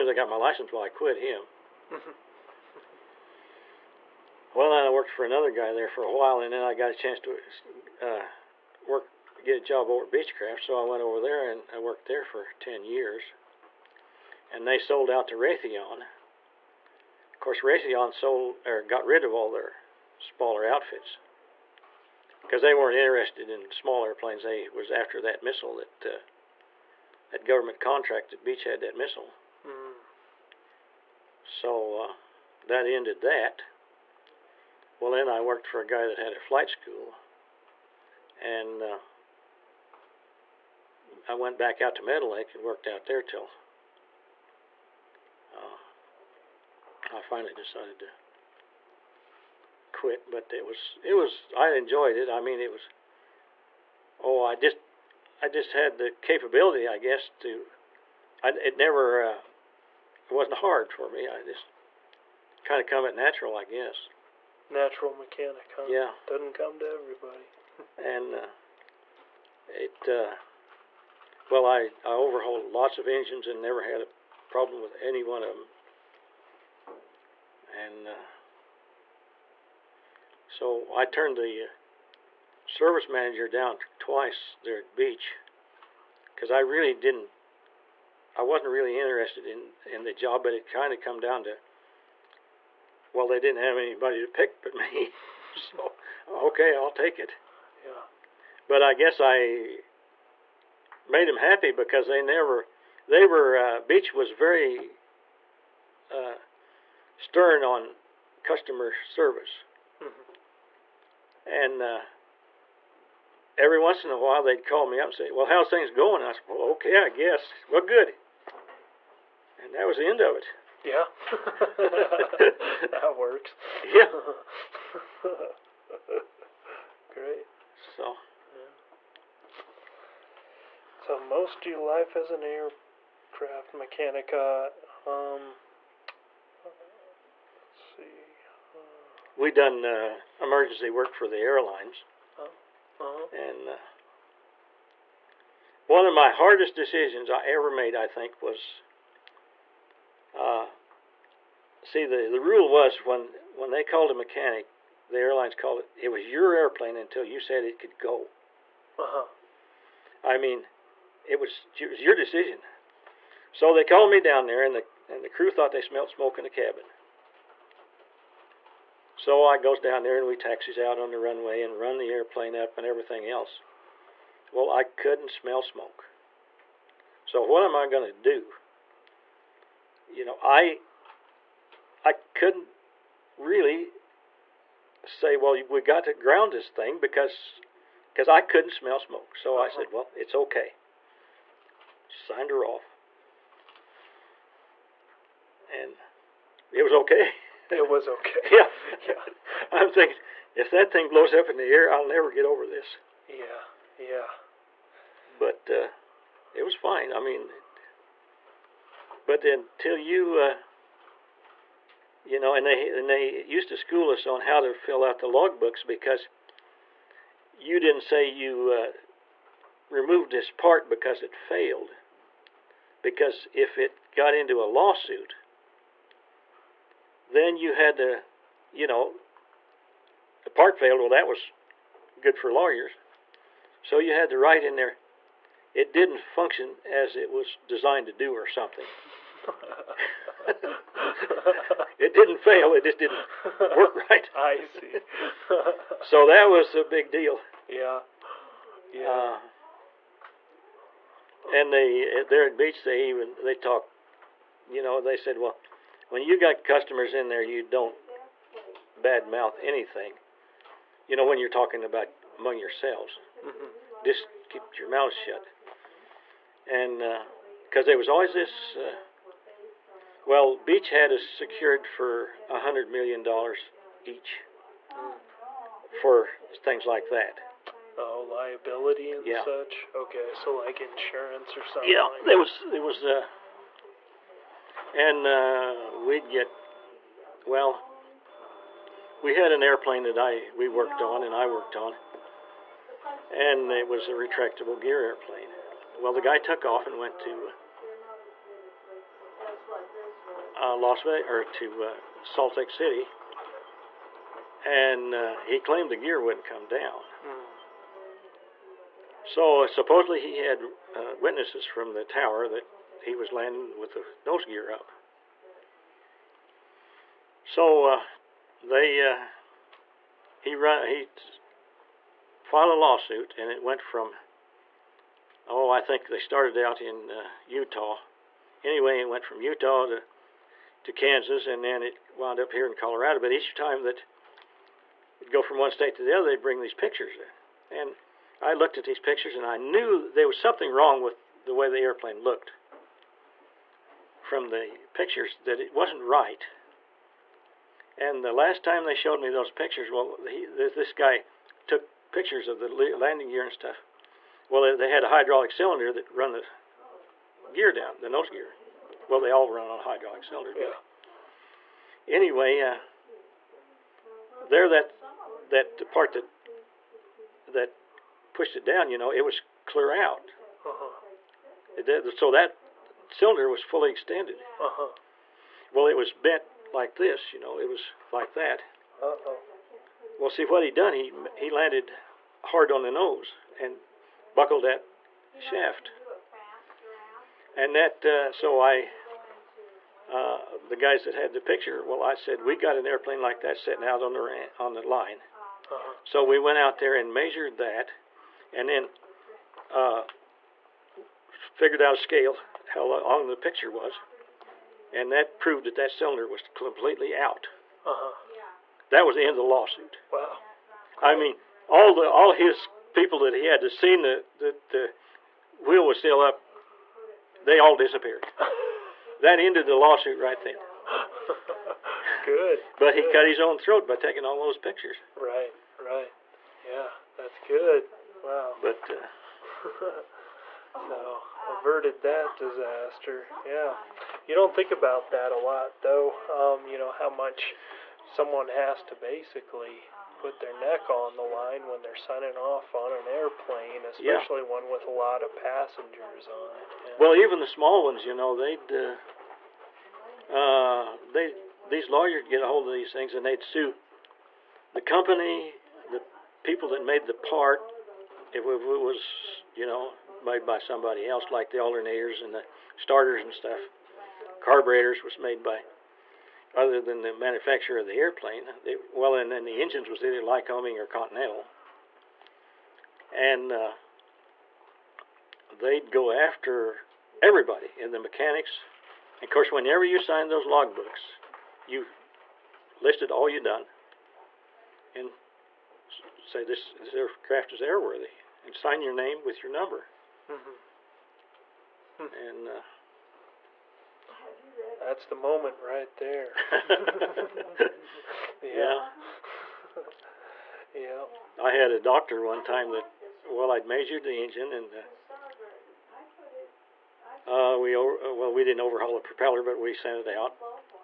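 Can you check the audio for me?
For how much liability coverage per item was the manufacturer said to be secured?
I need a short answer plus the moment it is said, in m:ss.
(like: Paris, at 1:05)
$100 million, at 4:32.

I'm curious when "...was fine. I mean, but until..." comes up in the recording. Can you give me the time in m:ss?
3:26.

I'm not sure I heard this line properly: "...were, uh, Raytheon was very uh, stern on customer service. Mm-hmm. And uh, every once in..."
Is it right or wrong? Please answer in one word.
wrong.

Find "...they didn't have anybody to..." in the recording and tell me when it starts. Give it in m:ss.
1:33.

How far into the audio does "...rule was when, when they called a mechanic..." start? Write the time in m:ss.
2:32.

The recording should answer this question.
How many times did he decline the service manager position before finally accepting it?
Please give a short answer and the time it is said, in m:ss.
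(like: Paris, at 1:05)
twice, at 1:23.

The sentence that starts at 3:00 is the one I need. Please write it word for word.
you know, I I couldn't really say, well, we got to ground this thing because because I couldn't smell smoke.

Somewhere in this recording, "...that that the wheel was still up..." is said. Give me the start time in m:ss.
6:54.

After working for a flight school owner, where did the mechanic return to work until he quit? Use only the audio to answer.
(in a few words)
Meadow Lake.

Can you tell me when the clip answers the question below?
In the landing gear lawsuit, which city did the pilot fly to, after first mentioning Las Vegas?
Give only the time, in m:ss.
5:02.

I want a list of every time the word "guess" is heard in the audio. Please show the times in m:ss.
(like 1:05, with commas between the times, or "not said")
0:56, 1:03, 1:38, 1:57.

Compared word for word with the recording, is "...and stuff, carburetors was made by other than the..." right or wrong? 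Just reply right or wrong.
right.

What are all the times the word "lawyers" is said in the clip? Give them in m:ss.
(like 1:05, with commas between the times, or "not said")
3:52, 7:31.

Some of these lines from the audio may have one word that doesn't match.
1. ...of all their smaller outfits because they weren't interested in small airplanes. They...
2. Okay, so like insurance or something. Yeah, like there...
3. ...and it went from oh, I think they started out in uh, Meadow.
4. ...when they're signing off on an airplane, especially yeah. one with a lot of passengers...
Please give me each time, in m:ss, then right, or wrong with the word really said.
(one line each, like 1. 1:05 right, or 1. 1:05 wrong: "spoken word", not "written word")
1. 0:19 right
2. 4:39 right
3. 5:23 wrong: "Utah", not "Meadow"
4. 7:21 right.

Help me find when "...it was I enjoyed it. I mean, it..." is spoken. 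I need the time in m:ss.
0:51.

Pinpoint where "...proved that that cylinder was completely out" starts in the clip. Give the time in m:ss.
6:45.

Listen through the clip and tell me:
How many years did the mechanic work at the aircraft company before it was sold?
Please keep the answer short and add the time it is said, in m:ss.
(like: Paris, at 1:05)
10, at 0:12.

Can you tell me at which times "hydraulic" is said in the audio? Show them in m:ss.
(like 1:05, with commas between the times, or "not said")
5:55, 5:59.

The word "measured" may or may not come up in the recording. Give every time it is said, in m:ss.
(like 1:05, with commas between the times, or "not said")
6:37, 8:23.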